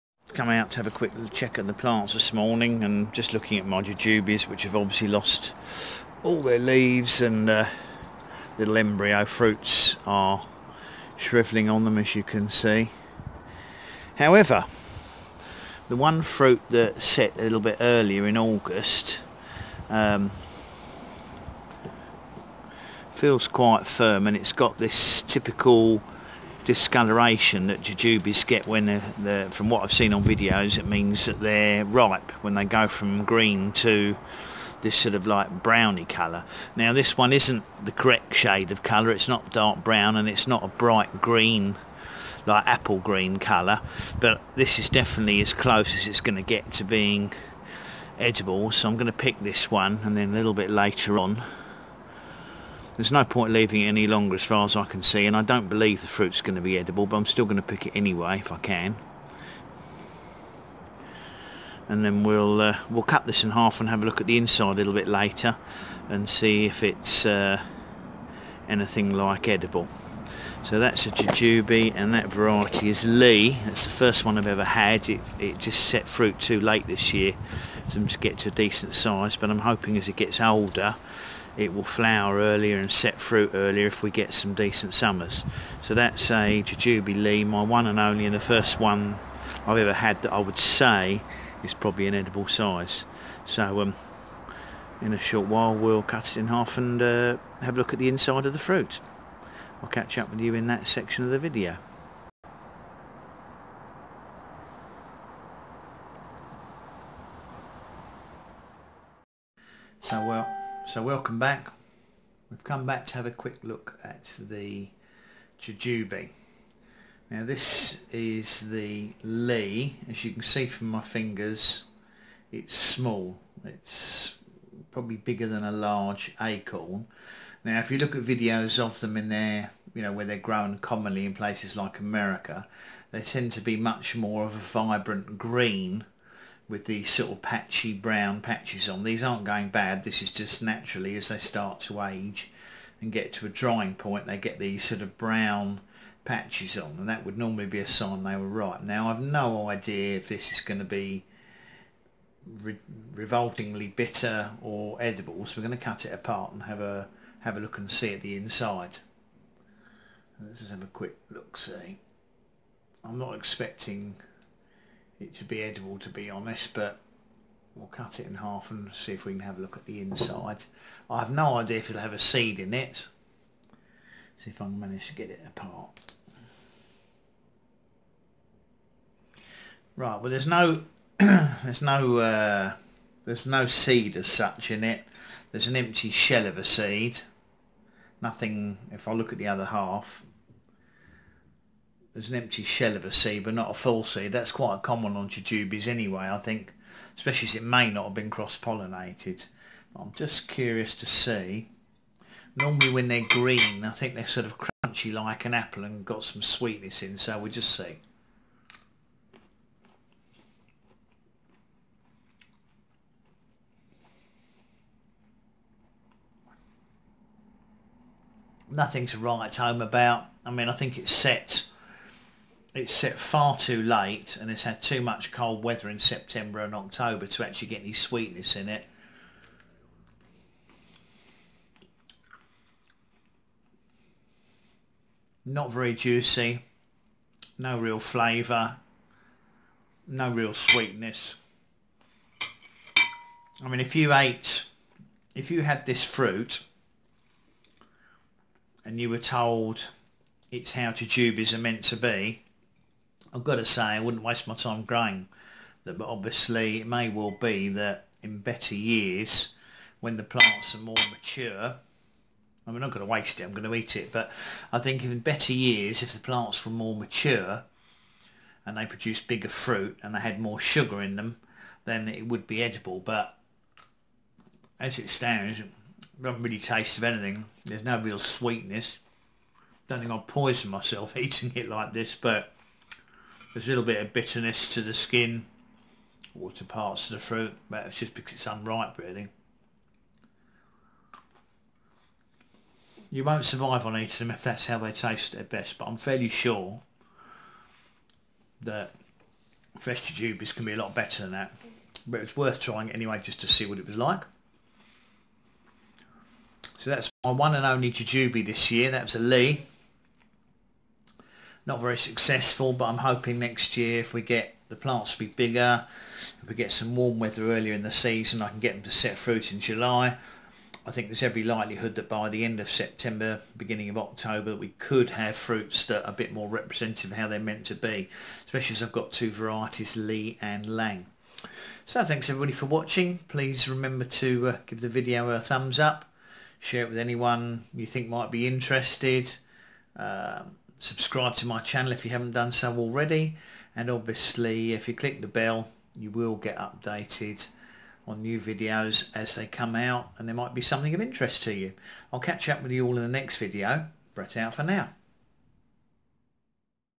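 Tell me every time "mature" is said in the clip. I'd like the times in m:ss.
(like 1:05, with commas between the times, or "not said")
4:21, 4:26.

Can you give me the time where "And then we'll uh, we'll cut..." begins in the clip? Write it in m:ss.
1:01.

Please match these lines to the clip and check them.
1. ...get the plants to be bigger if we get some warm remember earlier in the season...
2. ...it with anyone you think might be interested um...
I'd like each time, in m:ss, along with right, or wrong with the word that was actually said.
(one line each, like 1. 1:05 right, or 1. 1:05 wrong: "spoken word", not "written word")
1. 5:14 wrong: "weather", not "remember"
2. 5:36 right.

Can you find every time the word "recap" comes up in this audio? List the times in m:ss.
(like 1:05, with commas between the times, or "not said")
not said.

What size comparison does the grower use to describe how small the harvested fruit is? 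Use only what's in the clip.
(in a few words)
A large acorn.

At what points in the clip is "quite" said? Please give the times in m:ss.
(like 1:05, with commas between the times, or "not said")
0:23, 3:14.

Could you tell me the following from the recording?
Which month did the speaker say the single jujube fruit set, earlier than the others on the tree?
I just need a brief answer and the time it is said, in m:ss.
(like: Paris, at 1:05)
August, at 0:18.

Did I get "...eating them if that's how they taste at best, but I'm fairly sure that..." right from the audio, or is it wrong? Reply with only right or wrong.
right.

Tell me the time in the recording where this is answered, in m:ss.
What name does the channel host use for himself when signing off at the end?
5:54.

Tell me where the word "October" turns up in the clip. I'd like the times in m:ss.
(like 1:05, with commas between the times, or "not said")
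3:46, 5:23.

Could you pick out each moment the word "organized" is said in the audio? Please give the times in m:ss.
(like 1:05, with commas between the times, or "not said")
not said.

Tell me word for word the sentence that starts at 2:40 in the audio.
Let's just have a quick look see.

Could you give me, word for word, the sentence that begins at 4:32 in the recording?
But as it stands, I haven't really taste of anything.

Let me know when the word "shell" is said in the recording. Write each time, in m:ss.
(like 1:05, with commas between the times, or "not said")
3:06, 3:12.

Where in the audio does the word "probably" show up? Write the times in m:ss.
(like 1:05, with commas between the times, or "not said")
1:31, 2:04.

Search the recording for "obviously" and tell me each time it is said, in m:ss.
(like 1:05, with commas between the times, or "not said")
0:04, 4:16, 5:43.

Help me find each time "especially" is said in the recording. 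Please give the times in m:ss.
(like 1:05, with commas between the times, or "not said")
3:17, 5:28.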